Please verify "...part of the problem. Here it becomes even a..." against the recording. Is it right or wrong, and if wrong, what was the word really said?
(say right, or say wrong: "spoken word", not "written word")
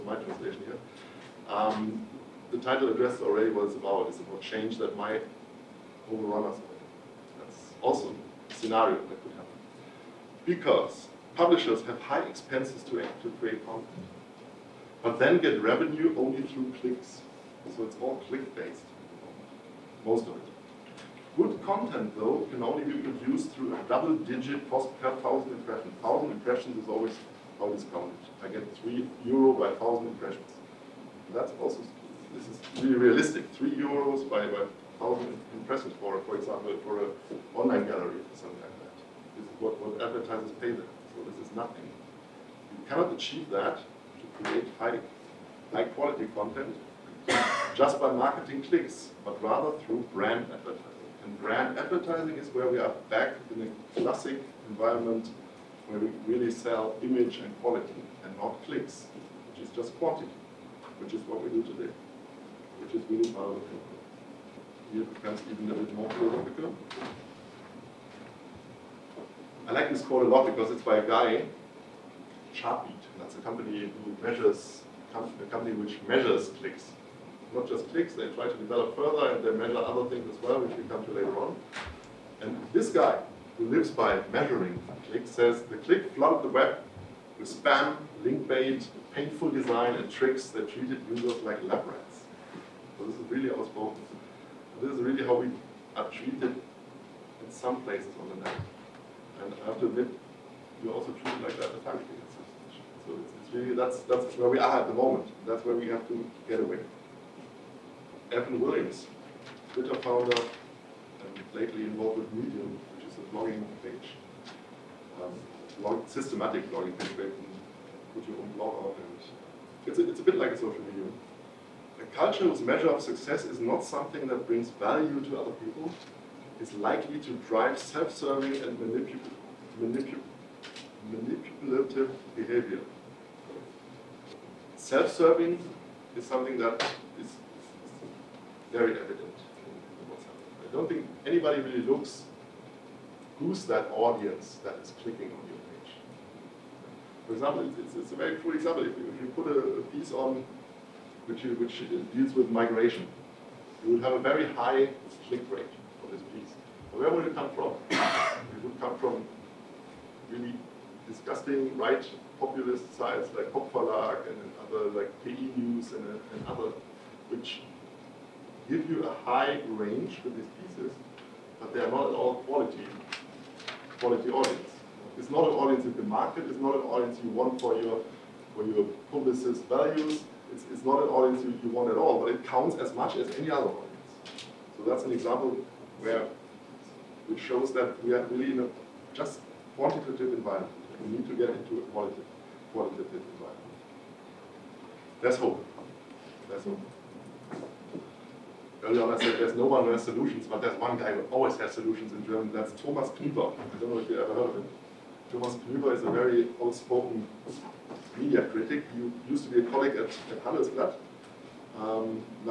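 right.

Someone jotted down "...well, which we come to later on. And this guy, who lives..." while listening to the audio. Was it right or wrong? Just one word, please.
right.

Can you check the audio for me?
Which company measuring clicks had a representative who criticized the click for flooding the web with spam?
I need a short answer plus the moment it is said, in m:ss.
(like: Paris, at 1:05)
Chartbeat, at 1:12.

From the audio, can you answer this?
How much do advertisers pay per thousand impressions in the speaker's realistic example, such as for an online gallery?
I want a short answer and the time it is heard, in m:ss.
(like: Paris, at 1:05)
3 euros, at 0:28.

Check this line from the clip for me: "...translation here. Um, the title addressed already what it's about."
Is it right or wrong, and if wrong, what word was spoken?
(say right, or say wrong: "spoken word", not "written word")
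right.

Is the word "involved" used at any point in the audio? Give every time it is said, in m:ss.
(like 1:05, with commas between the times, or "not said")
1:51.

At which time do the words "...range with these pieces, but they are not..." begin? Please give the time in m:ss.
2:49.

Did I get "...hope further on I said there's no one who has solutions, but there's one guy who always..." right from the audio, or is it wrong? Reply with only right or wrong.
wrong.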